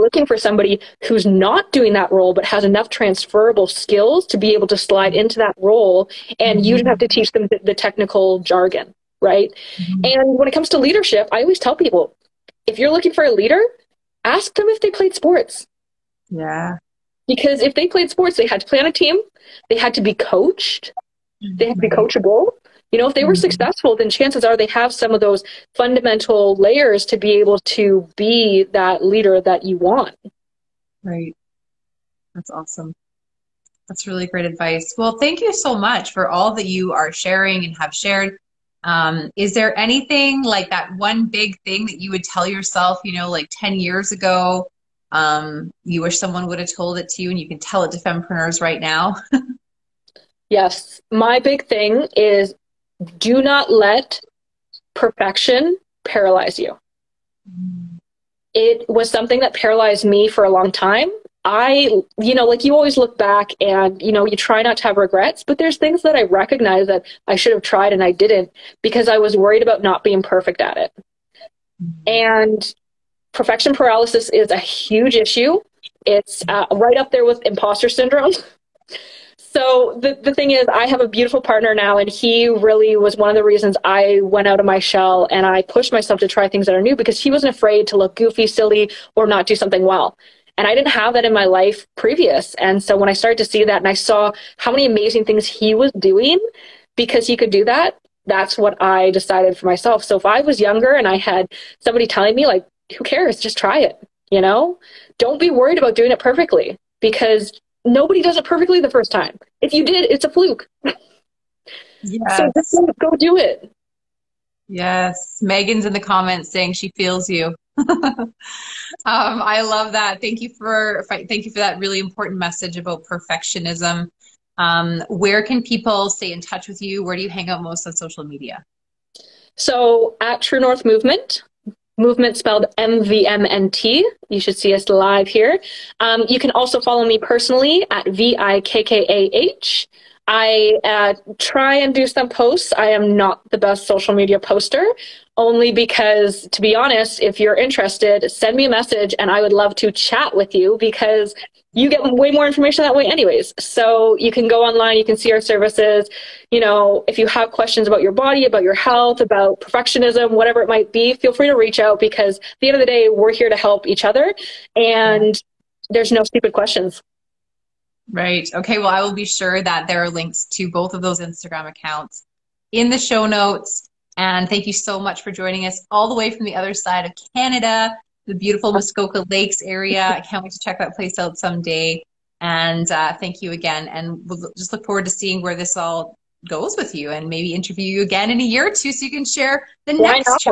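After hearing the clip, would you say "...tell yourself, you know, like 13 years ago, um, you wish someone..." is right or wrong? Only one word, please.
wrong.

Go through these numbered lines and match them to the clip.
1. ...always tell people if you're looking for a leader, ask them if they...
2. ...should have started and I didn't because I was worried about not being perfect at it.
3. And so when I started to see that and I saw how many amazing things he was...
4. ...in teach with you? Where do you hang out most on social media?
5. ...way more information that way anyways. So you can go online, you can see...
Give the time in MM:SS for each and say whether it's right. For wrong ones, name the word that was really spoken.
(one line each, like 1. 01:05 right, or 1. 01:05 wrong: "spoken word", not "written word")
1. 00:11 right
2. 01:07 wrong: "tried", not "started"
3. 01:32 right
4. 02:06 wrong: "touch", not "teach"
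5. 02:32 right.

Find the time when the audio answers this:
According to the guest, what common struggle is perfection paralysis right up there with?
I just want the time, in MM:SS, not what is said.
01:17.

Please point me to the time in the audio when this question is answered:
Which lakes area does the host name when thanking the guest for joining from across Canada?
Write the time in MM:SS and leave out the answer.
02:58.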